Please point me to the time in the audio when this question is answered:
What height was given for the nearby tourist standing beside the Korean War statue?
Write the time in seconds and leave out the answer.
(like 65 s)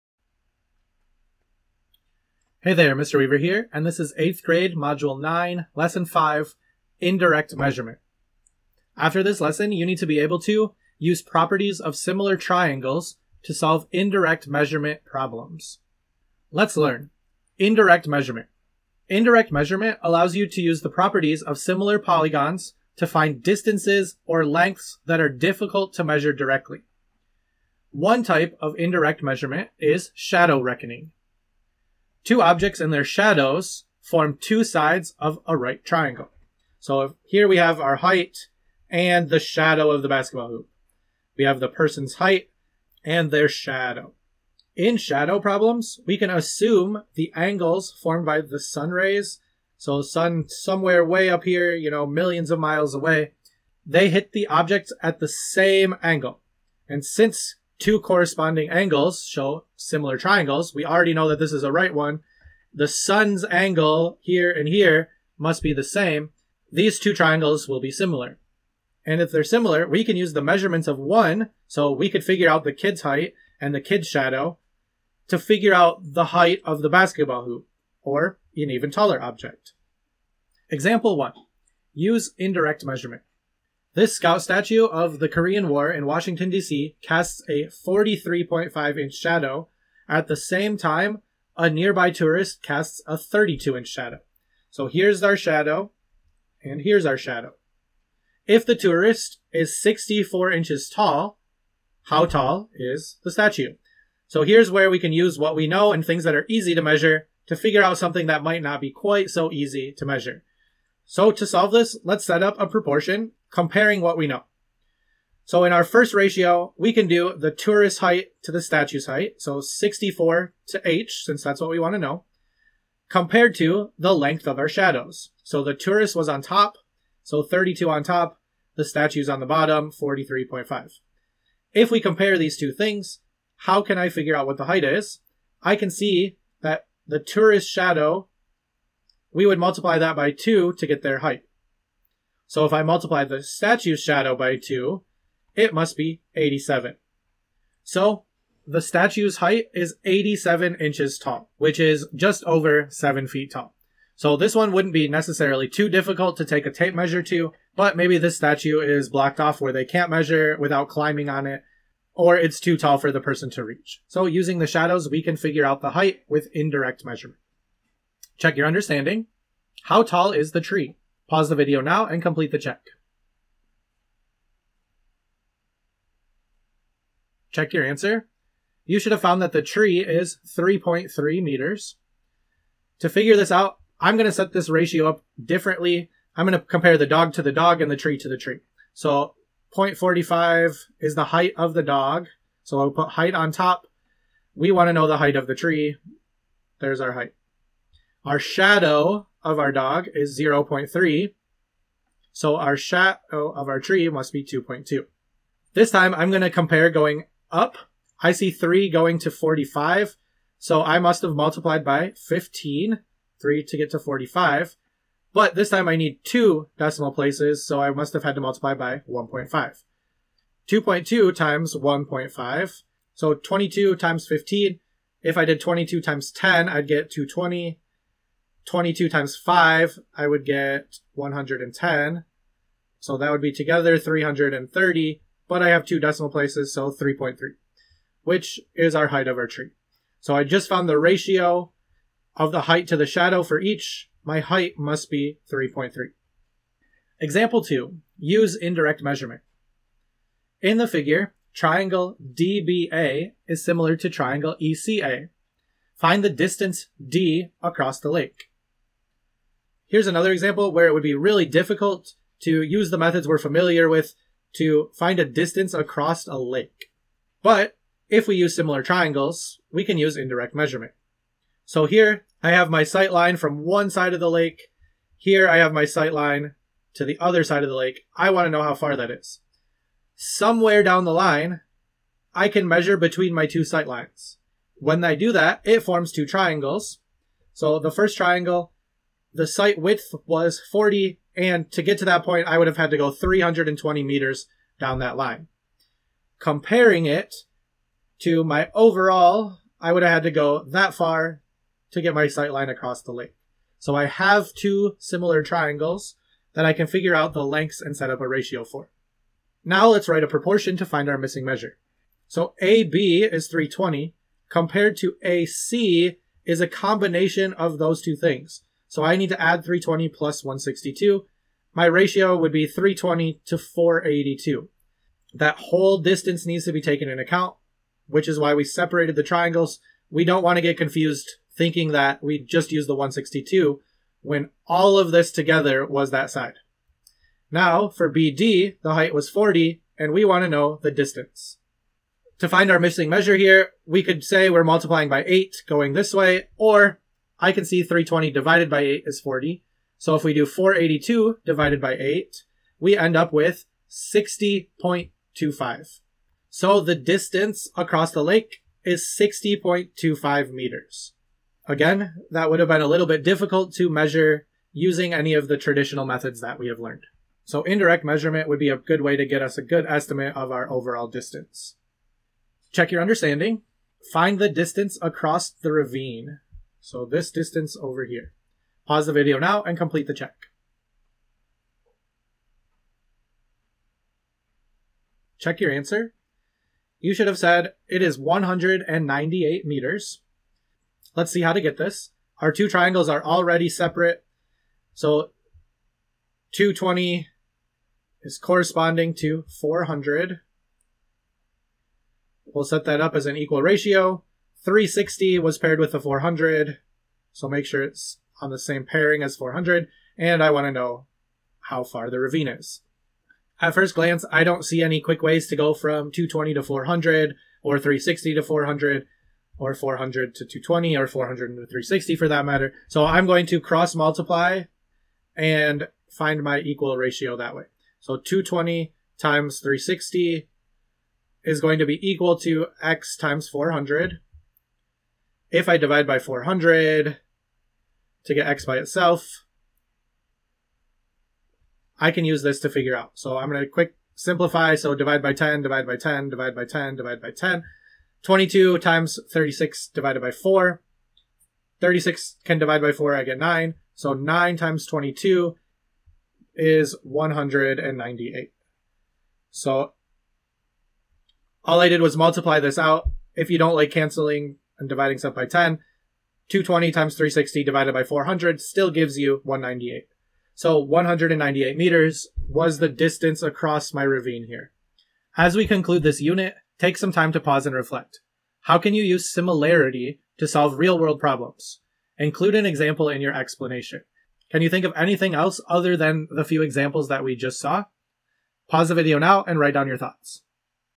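99 s.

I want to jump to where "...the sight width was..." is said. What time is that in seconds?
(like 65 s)
289 s.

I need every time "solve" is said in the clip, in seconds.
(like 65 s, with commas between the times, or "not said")
13 s, 111 s, 480 s.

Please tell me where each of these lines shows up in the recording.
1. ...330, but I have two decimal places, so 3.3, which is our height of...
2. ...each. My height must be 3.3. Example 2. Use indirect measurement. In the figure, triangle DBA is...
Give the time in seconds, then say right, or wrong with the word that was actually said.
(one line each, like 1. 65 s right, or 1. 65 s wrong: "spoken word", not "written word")
1. 233 s right
2. 243 s right.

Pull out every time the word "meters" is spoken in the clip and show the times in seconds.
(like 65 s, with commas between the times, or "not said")
181 s, 294 s, 360 s, 389 s, 471 s.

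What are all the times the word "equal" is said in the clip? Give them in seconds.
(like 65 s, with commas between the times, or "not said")
403 s, 426 s, 432 s.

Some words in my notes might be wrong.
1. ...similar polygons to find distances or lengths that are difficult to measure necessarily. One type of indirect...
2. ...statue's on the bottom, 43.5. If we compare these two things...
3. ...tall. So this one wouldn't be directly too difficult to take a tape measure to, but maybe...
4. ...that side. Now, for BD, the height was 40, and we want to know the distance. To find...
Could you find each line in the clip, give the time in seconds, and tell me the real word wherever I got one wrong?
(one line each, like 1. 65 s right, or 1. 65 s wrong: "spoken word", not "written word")
1. 21 s wrong: "directly", not "necessarily"
2. 128 s right
3. 153 s wrong: "necessarily", not "directly"
4. 336 s right.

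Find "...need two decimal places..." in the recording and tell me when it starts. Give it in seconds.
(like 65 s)
215 s.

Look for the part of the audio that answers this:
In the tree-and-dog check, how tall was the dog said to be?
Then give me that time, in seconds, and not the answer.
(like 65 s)
189 s.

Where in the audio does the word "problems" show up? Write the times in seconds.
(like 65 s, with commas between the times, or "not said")
15 s, 45 s, 481 s.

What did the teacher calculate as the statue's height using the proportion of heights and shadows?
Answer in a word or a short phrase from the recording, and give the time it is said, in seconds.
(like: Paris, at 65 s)
87 inches, at 150 s.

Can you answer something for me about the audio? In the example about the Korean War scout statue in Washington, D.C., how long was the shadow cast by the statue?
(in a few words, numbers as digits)
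43.5 inches.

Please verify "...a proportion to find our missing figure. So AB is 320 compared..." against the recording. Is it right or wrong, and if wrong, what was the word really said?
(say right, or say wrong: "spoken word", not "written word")
wrong: "measure", not "figure".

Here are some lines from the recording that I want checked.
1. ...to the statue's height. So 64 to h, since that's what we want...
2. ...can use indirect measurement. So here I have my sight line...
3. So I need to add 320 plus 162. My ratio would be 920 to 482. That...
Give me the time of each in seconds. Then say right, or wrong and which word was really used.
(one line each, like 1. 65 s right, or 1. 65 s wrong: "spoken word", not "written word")
1. 118 s right
2. 269 s right
3. 318 s wrong: "320", not "920".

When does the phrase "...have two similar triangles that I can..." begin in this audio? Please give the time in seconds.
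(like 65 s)
304 s.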